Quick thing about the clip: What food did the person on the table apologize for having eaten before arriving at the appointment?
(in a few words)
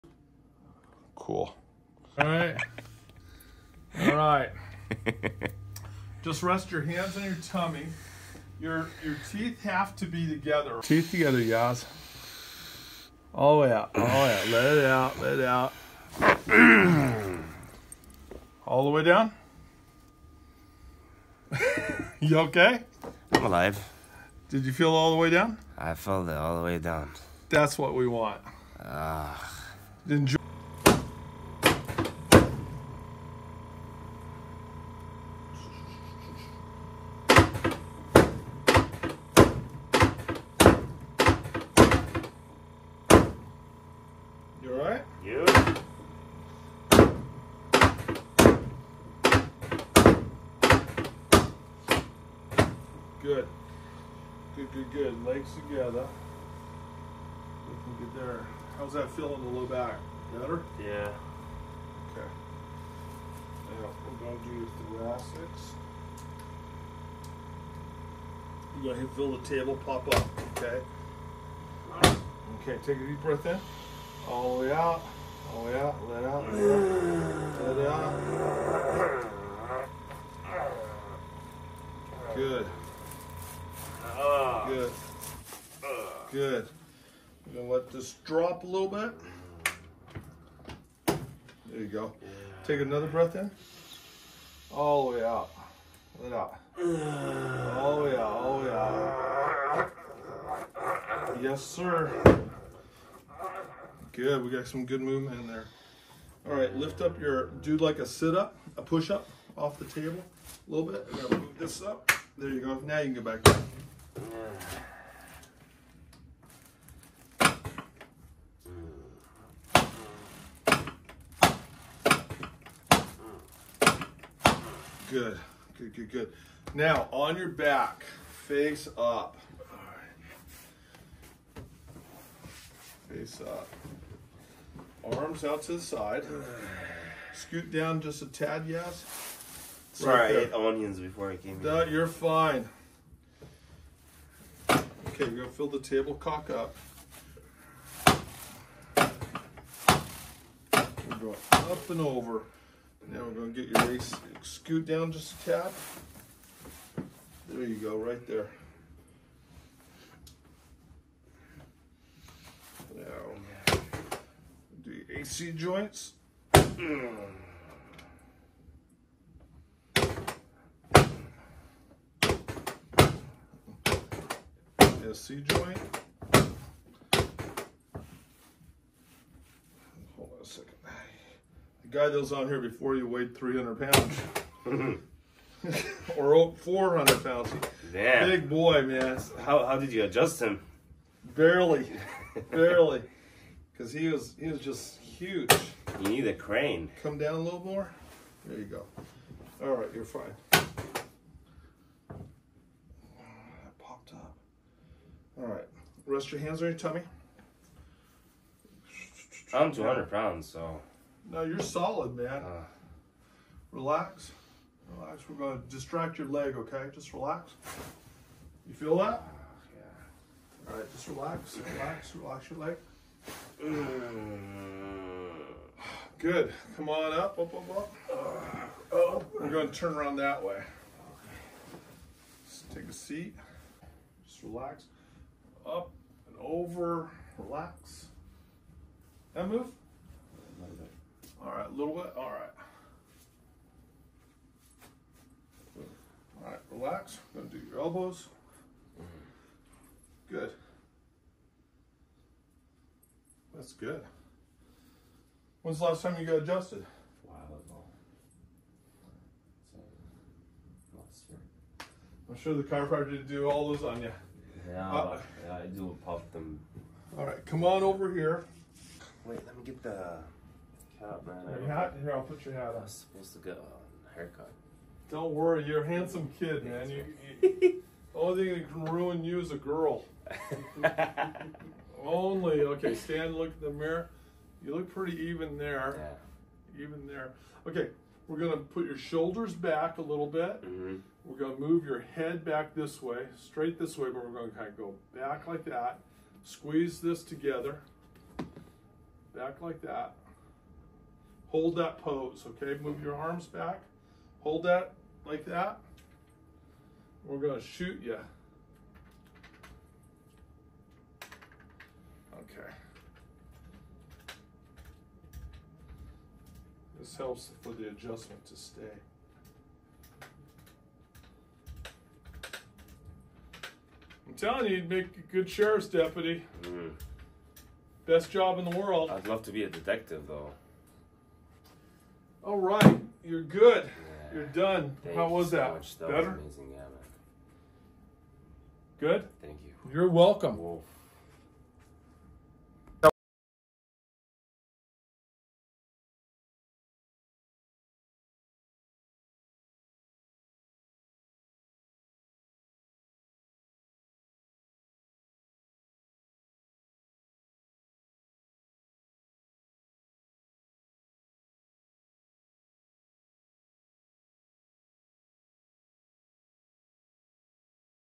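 onions.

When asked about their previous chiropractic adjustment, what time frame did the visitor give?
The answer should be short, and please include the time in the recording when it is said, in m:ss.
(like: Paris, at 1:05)
last year, at 4:20.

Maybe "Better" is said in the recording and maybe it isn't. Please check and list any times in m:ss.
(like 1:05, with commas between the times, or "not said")
1:00, 5:36.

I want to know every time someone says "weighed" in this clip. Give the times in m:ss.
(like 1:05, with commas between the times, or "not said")
3:03.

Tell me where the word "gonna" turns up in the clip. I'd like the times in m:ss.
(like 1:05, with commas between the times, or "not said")
1:27, 2:25, 2:33, 4:07, 5:07.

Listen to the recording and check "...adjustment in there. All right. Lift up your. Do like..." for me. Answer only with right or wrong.
wrong.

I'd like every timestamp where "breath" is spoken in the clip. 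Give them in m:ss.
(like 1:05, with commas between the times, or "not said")
1:13, 1:33.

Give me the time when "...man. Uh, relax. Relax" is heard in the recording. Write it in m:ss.
3:32.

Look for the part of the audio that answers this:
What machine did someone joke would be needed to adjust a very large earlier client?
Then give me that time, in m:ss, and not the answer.
3:16.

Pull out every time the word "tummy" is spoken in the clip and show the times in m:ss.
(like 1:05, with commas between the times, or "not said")
0:07, 3:26.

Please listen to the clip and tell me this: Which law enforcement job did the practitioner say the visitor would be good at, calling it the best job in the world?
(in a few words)
sheriff's deputy.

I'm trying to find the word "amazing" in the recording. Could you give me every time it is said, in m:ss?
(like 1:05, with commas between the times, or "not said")
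5:36.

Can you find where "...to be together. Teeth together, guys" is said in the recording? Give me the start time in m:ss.
0:09.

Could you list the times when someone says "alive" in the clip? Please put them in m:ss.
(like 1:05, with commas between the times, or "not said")
0:23.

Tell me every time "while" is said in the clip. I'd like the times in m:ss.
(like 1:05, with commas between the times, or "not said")
4:17.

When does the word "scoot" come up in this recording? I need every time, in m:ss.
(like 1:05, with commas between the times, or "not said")
2:17, 2:34.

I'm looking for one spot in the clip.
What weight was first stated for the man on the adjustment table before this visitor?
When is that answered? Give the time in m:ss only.
3:03.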